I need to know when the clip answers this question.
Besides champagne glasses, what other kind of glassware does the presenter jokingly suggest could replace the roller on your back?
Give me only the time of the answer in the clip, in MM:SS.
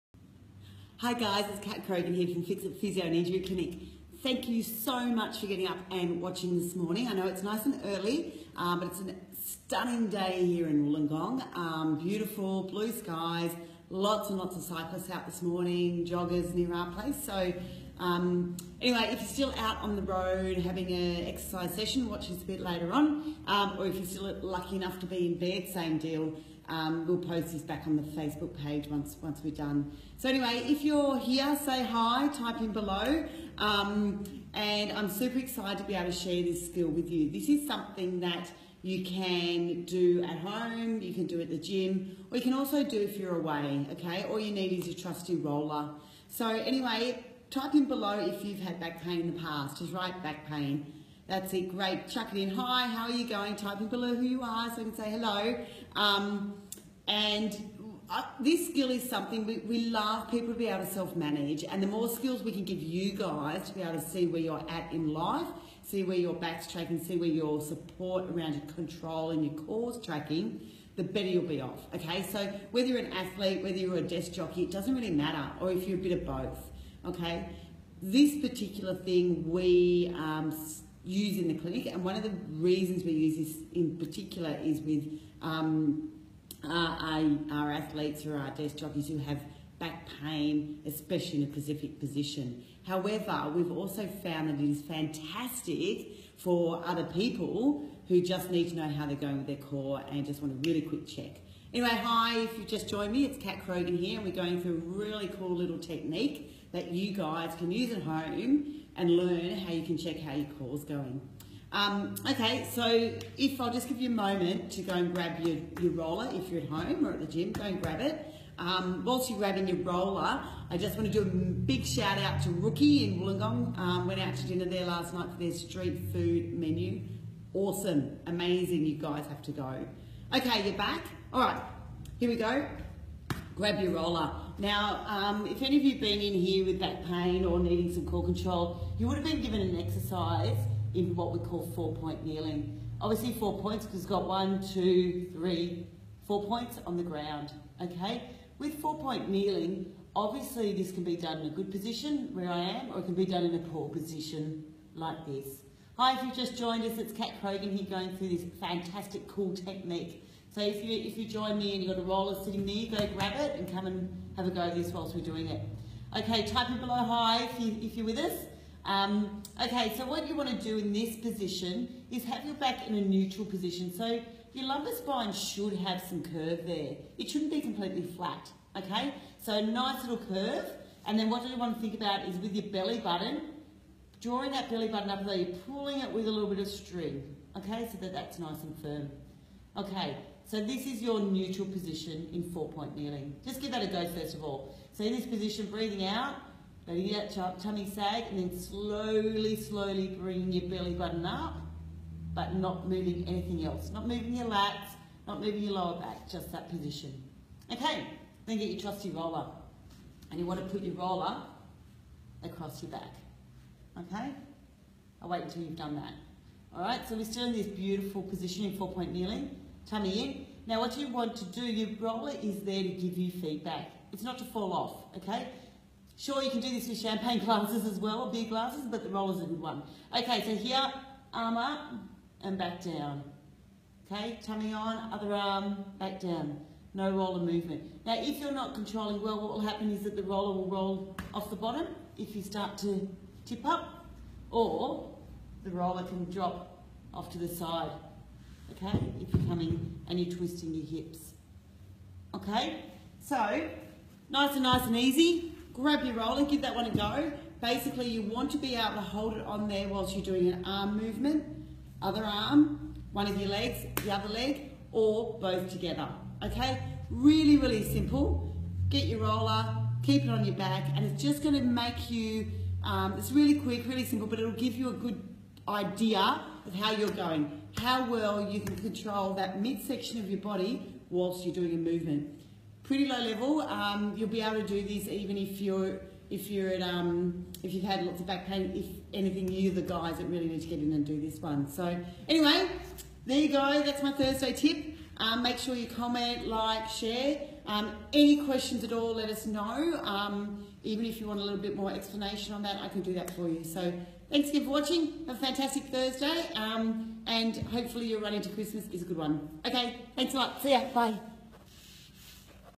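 03:48.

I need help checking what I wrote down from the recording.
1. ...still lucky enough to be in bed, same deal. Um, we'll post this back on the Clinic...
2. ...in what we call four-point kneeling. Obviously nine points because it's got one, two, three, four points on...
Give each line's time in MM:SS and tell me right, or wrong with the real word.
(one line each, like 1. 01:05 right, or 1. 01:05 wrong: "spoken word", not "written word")
1. 00:24 wrong: "Facebook", not "Clinic"
2. 02:20 wrong: "four", not "nine".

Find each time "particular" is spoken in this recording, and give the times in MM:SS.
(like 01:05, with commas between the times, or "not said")
01:18, 01:23.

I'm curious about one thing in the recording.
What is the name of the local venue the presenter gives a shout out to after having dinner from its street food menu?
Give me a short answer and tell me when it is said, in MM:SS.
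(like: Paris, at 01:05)
Rookie, at 02:02.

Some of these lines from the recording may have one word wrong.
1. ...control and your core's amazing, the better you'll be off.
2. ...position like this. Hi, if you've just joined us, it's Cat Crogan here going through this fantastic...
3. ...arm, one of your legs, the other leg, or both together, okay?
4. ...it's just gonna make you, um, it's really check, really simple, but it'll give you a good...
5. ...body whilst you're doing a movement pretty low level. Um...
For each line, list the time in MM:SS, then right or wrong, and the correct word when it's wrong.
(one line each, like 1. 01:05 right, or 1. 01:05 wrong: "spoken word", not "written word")
1. 01:08 wrong: "tracking", not "amazing"
2. 02:33 right
3. 04:22 right
4. 04:31 wrong: "quick", not "check"
5. 04:40 right.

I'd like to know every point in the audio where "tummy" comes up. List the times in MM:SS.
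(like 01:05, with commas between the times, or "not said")
03:17, 03:39, 03:54.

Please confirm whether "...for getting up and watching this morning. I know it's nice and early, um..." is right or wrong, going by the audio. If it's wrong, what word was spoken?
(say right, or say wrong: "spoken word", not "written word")
right.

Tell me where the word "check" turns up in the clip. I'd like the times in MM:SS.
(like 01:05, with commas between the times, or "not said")
01:41, 01:49.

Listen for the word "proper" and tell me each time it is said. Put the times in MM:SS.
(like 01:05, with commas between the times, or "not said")
not said.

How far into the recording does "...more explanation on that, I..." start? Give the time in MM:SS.
05:01.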